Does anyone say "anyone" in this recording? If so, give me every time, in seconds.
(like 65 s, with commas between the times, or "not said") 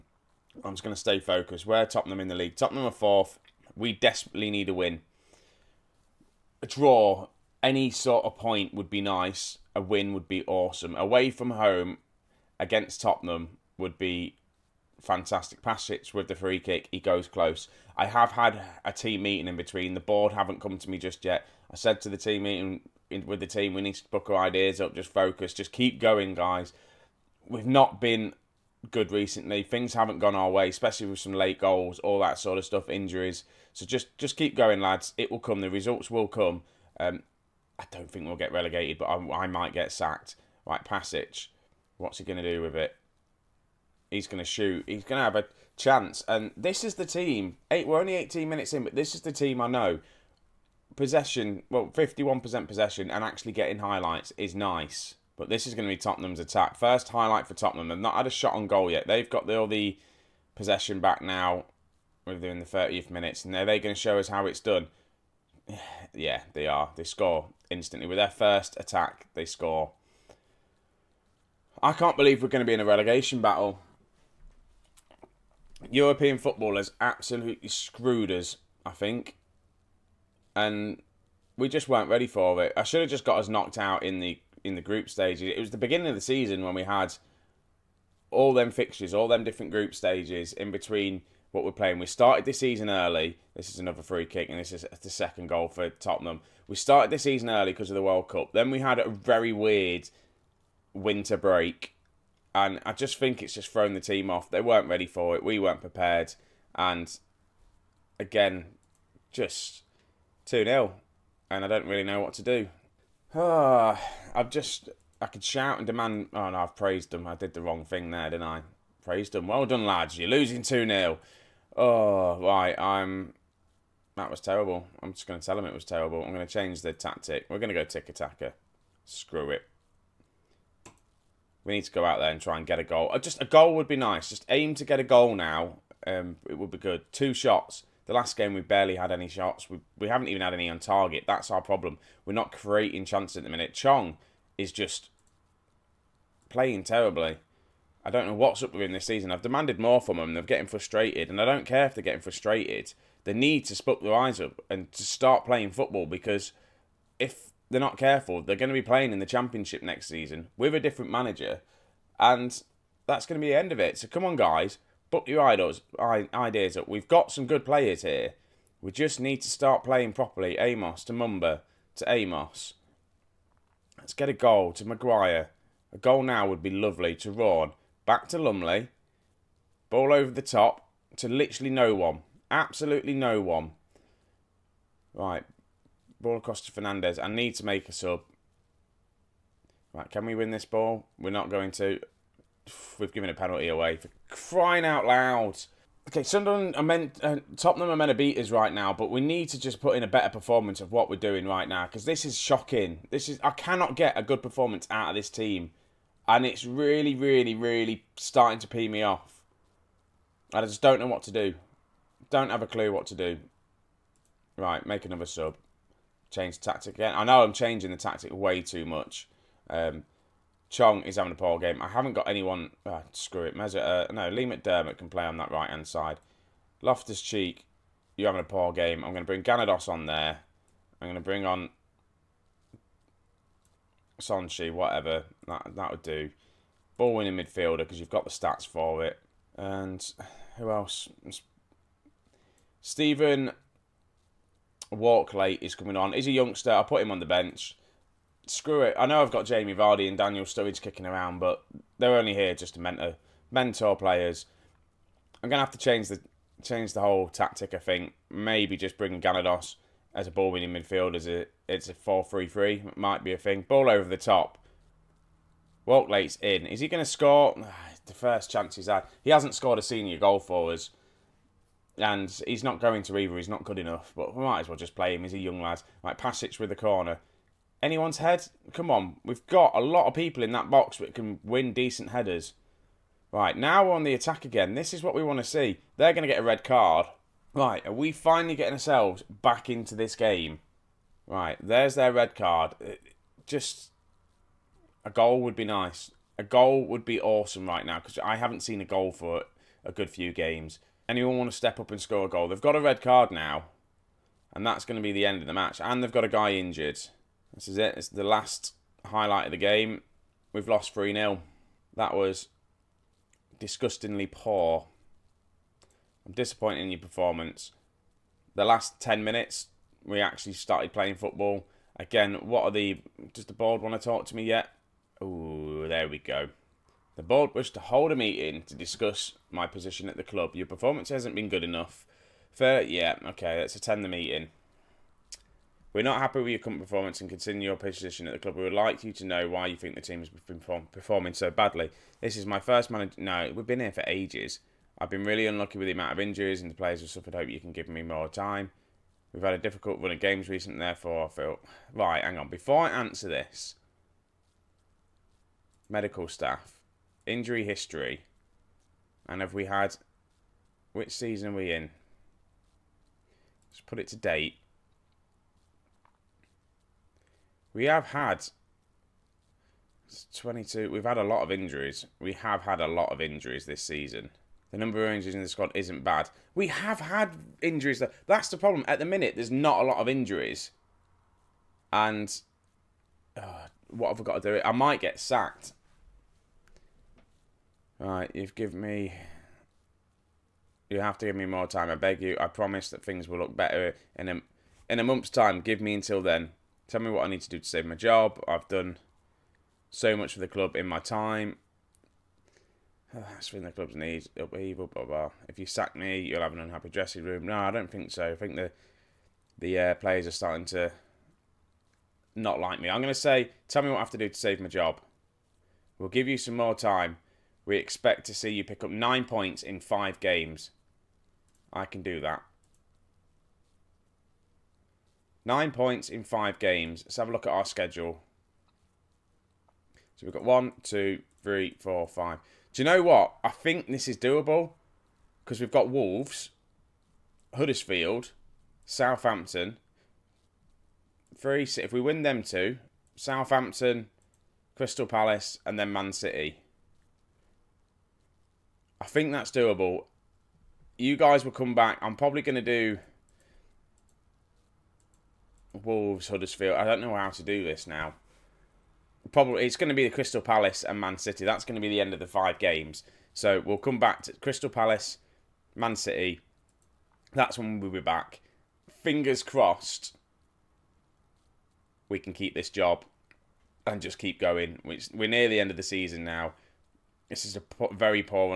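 222 s, 277 s, 301 s.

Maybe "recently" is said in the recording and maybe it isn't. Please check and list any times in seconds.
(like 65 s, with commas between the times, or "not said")
29 s, 350 s.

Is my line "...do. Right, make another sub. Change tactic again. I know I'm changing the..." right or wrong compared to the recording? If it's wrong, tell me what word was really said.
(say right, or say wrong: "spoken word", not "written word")
right.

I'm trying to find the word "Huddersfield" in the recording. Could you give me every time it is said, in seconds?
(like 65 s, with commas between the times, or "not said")
437 s, 456 s.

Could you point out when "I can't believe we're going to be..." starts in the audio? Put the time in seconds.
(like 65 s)
71 s.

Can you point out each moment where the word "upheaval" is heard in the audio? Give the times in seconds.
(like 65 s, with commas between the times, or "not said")
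404 s.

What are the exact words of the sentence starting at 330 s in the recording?
Your performance hasn't been good enough.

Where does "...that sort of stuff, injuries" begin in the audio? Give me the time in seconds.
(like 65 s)
32 s.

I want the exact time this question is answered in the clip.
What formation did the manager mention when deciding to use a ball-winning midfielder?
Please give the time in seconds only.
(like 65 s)
261 s.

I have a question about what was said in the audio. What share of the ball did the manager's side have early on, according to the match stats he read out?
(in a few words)
51%.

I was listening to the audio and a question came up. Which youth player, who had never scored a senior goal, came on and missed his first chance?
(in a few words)
Stephen Walklate.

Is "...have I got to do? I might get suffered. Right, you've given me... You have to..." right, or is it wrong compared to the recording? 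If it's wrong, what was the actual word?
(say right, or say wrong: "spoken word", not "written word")
wrong: "sacked", not "suffered".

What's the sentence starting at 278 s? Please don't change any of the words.
Come on, we've got a lot of people in that box that can win decent headers.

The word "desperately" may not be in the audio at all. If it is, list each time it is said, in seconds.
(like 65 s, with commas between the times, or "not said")
3 s.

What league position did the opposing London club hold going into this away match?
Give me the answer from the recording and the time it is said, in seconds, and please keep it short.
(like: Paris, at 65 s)
4th, at 2 s.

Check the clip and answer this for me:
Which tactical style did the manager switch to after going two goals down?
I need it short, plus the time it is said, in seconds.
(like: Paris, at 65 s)
Tiki-taka, at 127 s.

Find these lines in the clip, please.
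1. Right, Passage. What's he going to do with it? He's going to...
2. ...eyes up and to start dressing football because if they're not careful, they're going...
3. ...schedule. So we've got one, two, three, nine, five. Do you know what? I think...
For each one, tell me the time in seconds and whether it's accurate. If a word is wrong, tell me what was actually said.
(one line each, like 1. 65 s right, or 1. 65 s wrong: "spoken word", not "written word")
1. 40 s right
2. 154 s wrong: "playing", not "dressing"
3. 427 s wrong: "four", not "nine".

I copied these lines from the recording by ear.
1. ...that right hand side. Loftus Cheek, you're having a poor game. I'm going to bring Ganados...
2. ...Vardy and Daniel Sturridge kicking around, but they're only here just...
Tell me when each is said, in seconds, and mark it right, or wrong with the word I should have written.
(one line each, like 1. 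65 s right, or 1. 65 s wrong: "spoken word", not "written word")
1. 225 s right
2. 249 s right.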